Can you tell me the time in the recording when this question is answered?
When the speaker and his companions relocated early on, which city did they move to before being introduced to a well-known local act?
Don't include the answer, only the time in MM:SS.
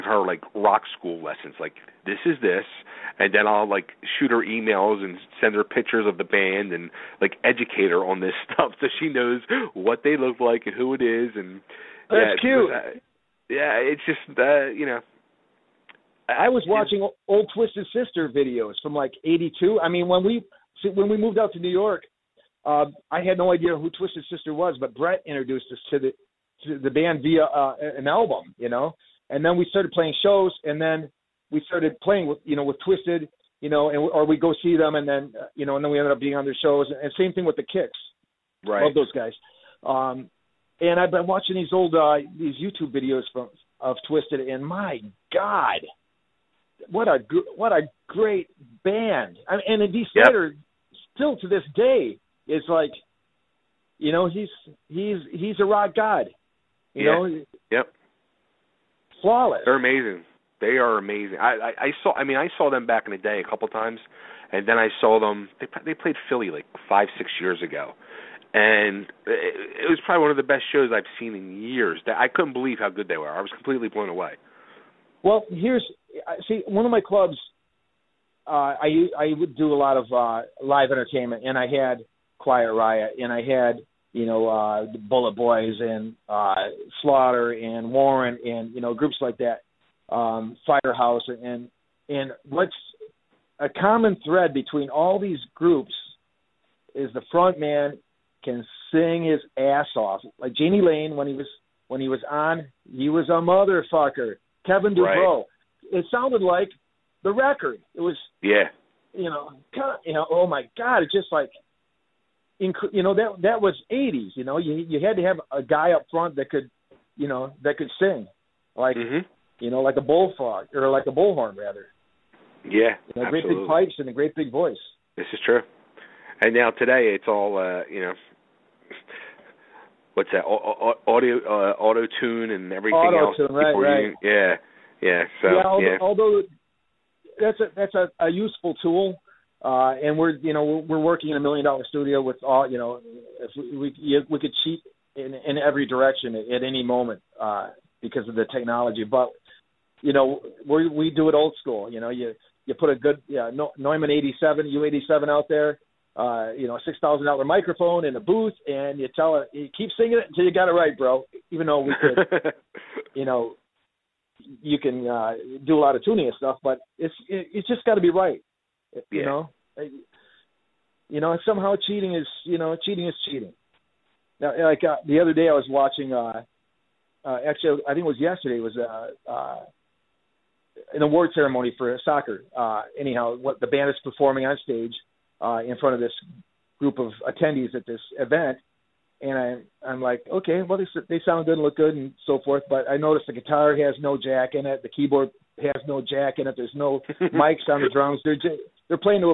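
00:21.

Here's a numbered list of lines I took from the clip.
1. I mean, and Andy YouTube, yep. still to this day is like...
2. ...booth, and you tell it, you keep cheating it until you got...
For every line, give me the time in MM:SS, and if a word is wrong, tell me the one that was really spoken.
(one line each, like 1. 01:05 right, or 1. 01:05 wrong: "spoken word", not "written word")
1. 00:49 wrong: "Slater", not "YouTube"
2. 02:38 wrong: "singing", not "cheating".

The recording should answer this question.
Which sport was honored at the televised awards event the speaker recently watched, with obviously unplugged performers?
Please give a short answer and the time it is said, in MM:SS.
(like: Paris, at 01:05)
Soccer, at 03:02.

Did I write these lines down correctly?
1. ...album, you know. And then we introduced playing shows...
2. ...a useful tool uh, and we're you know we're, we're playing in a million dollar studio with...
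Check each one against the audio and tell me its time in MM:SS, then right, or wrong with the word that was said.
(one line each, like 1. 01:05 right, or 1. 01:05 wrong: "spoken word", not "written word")
1. 00:28 wrong: "started", not "introduced"
2. 02:18 wrong: "working", not "playing".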